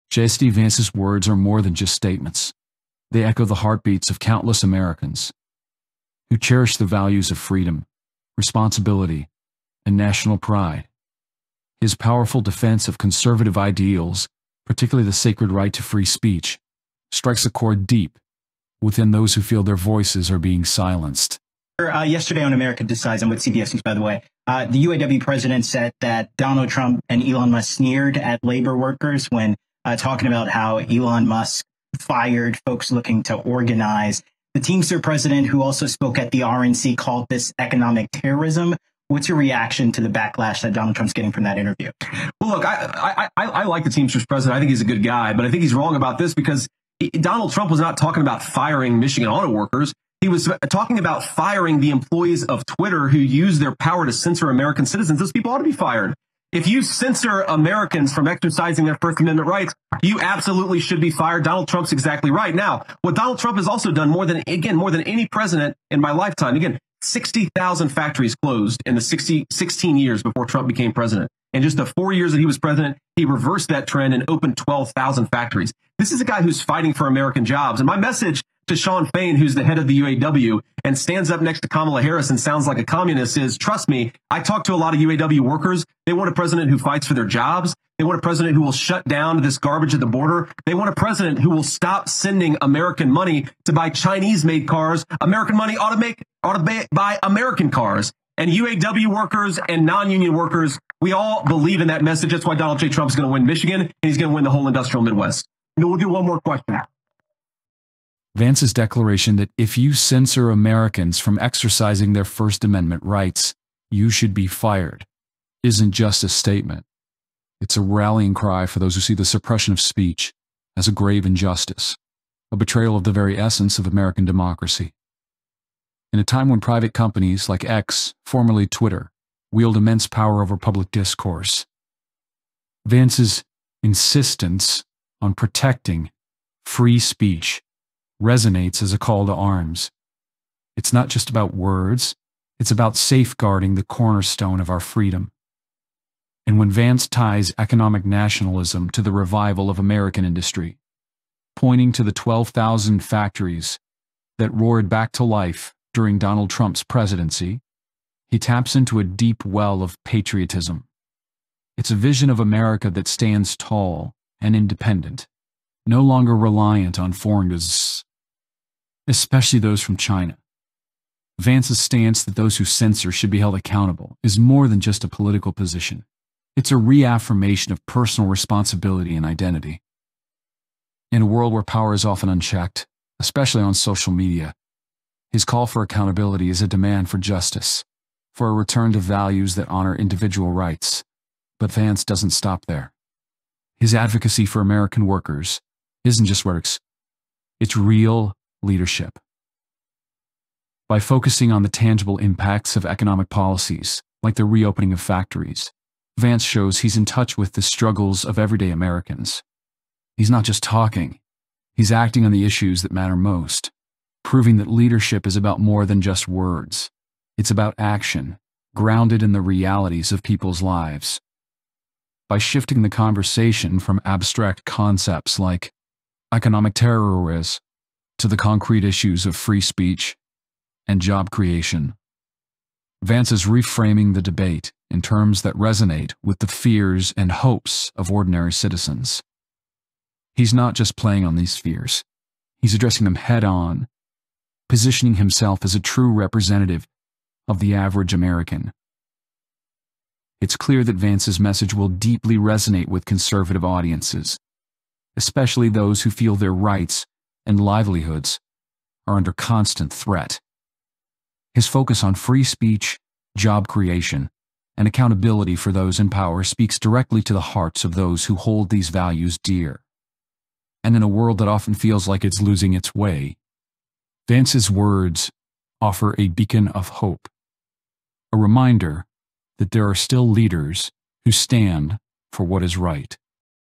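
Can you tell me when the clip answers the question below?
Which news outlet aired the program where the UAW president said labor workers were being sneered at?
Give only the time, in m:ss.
0:23.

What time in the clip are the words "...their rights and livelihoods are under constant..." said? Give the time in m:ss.
4:16.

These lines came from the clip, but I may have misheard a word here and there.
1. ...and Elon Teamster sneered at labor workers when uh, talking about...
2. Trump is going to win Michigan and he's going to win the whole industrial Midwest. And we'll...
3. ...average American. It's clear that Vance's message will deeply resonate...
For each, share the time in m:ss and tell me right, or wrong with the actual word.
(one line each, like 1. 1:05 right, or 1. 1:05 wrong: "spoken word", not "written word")
1. 0:27 wrong: "Musk", not "Teamster"
2. 1:42 right
3. 4:07 right.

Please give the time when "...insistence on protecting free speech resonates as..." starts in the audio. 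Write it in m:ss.
2:13.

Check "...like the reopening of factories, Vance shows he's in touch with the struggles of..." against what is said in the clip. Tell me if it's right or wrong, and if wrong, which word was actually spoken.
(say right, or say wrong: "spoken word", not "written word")
right.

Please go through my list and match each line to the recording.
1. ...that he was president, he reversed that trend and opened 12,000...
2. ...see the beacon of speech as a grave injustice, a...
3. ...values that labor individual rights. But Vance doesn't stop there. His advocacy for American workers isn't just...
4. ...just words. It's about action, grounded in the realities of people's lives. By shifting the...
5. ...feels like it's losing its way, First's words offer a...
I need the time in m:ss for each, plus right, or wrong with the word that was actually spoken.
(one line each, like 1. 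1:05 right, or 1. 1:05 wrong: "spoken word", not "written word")
1. 1:12 right
2. 1:59 wrong: "suppression", not "beacon"
3. 3:08 wrong: "honor", not "labor"
4. 3:36 right
5. 4:31 wrong: "Vance", not "First".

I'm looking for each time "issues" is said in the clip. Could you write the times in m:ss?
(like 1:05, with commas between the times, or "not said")
3:32, 3:48.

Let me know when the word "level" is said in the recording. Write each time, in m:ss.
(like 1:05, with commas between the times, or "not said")
not said.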